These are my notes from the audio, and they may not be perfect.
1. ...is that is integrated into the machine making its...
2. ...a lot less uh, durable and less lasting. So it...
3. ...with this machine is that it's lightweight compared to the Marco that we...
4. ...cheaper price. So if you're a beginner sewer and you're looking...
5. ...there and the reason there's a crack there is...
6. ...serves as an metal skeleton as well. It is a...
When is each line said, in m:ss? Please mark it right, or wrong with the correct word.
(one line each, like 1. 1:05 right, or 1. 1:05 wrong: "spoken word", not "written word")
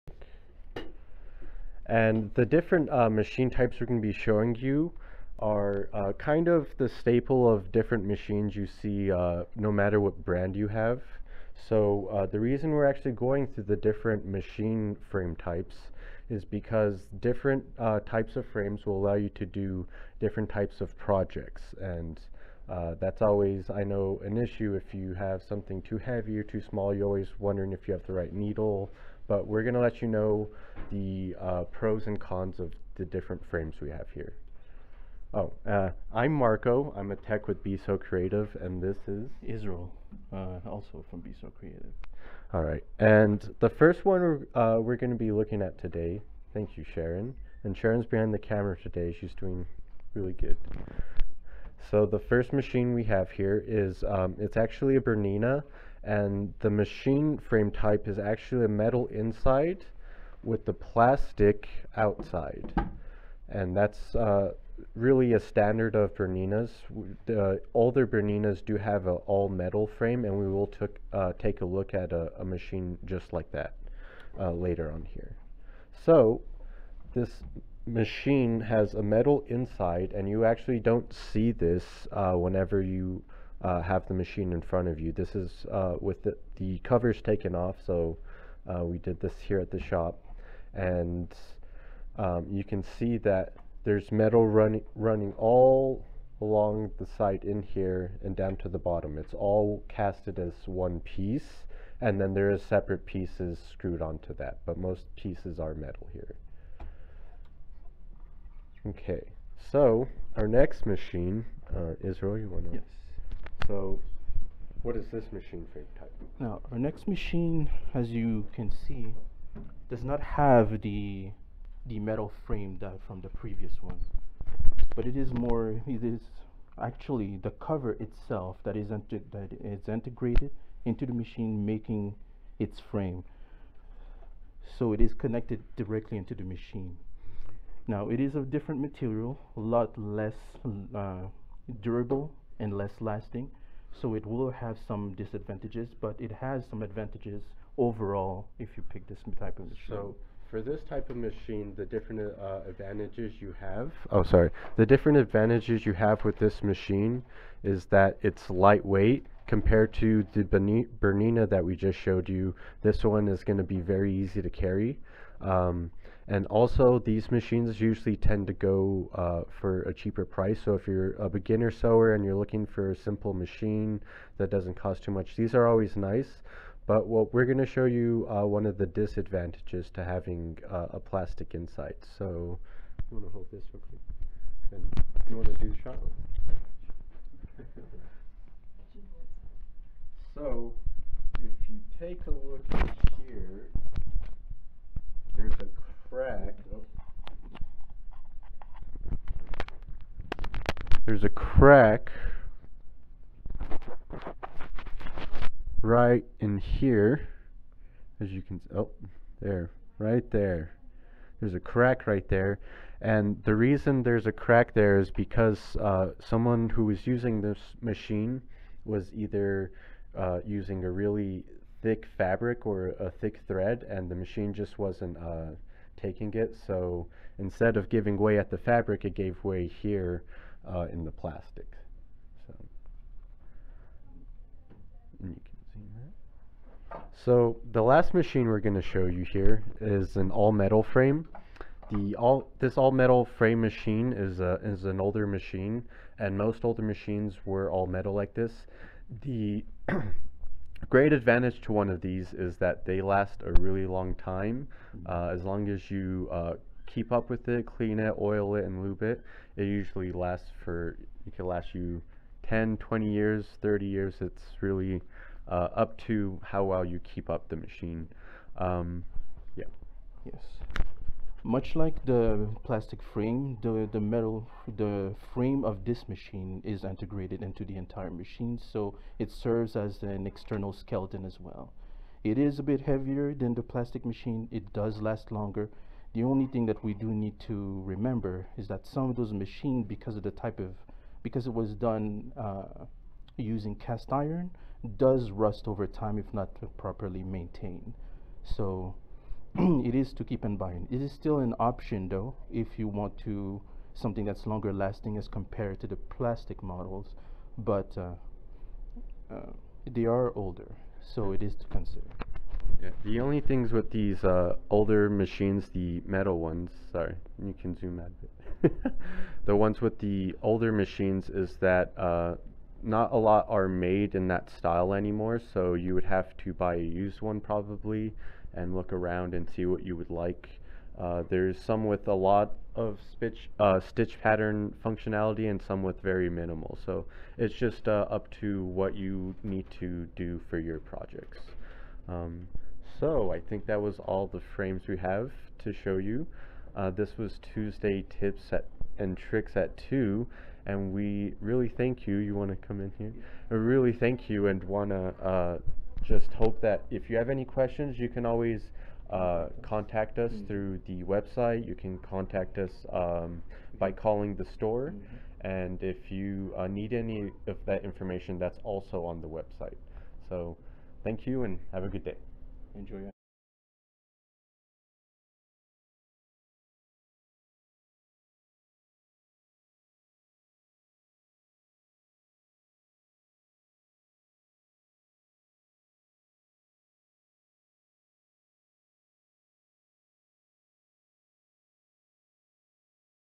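1. 2:08 right
2. 2:19 right
3. 2:36 wrong: "Bernina", not "Marco"
4. 2:49 right
5. 3:32 right
6. 4:39 wrong: "external", not "metal".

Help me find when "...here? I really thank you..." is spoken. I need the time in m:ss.
5:52.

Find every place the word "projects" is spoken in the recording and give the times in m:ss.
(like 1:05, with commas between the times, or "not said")
0:20, 5:40.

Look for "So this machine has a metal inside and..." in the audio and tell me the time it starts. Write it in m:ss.
1:16.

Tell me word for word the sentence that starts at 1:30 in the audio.
And um, you can see that there's metal run running all along the side in here and down to the bottom.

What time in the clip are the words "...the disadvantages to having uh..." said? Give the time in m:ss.
2:58.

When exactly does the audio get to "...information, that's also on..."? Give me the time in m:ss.
6:07.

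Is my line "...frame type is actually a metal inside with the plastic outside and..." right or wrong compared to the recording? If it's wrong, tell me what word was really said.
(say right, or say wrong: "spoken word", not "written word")
right.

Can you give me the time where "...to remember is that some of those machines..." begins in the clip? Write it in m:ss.
4:47.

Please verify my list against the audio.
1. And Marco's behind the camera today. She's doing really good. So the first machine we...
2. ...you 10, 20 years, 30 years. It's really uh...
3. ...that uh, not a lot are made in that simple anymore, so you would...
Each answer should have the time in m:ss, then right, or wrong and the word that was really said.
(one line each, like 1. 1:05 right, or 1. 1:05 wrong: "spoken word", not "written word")
1. 0:47 wrong: "Sharon", not "Marco"
2. 4:21 right
3. 5:21 wrong: "style", not "simple".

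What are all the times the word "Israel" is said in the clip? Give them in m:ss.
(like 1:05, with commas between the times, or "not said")
0:39, 1:52.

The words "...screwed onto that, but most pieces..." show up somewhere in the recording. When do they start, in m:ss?
1:43.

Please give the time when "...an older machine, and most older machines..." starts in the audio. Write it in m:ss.
4:04.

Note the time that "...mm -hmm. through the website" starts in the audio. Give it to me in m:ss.
6:00.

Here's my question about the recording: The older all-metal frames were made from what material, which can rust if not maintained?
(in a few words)
Cast iron.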